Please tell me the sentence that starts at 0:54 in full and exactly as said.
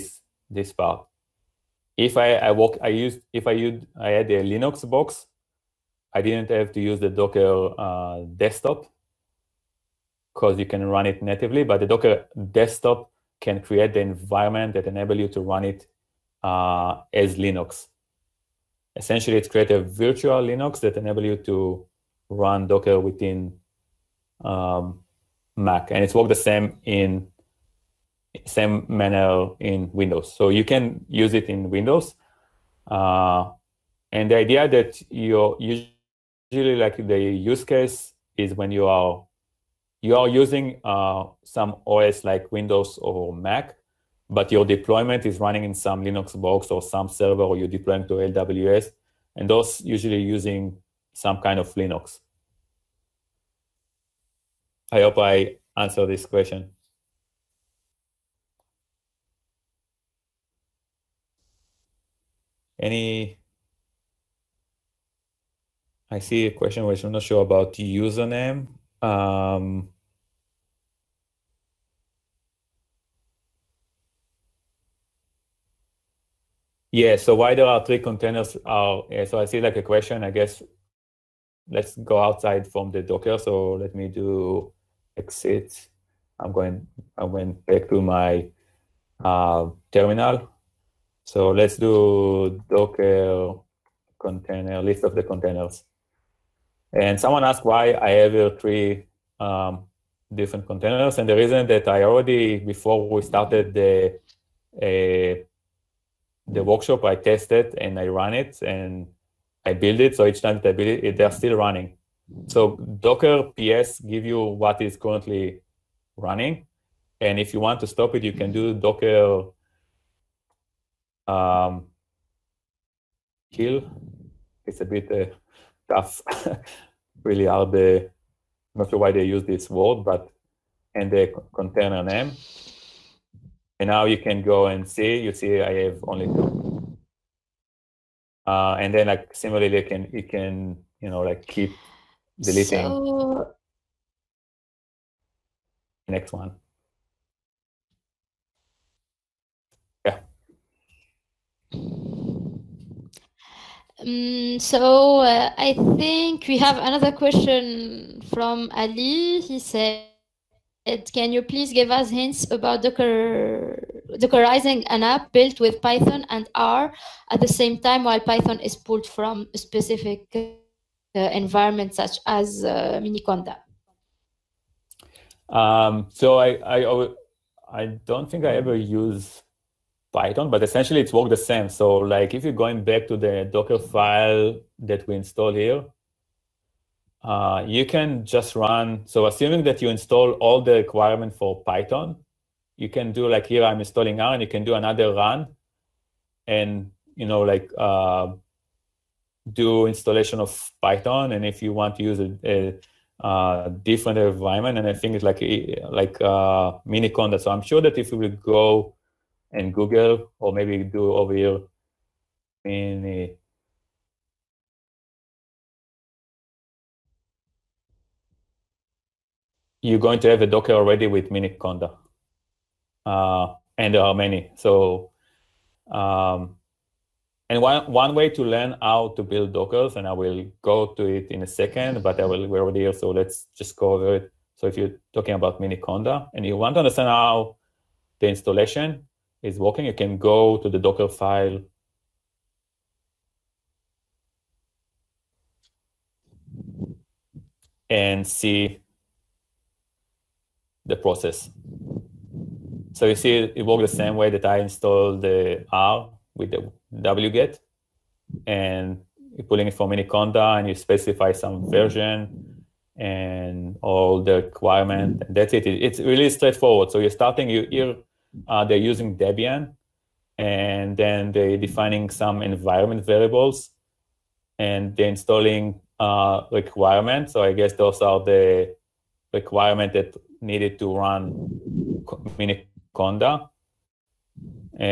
I hope I answer this question.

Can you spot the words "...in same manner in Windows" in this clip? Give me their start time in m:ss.
0:26.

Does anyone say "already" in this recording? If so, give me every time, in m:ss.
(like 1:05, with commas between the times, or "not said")
1:42, 3:40, 3:52.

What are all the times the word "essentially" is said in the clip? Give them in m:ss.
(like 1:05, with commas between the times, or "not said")
0:18, 3:00.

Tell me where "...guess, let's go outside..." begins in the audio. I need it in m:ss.
1:20.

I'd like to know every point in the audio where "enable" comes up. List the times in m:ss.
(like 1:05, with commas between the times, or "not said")
0:14, 0:20.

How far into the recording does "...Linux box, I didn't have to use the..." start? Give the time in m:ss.
0:04.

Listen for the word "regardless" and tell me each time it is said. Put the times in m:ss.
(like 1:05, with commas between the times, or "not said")
not said.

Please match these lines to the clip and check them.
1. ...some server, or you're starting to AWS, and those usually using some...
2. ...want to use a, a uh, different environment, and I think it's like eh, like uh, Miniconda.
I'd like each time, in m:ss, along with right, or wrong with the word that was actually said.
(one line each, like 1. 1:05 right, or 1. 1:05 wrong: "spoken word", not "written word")
1. 0:46 wrong: "deploying", not "starting"
2. 3:21 right.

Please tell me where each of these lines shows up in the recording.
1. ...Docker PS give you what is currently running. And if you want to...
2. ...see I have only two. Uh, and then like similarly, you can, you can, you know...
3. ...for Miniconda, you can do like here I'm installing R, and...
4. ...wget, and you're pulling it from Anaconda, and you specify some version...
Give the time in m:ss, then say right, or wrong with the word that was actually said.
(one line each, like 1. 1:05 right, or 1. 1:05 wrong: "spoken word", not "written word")
1. 1:52 right
2. 2:15 right
3. 3:11 wrong: "Python", not "Miniconda"
4. 4:16 right.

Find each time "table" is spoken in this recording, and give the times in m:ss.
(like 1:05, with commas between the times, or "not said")
not said.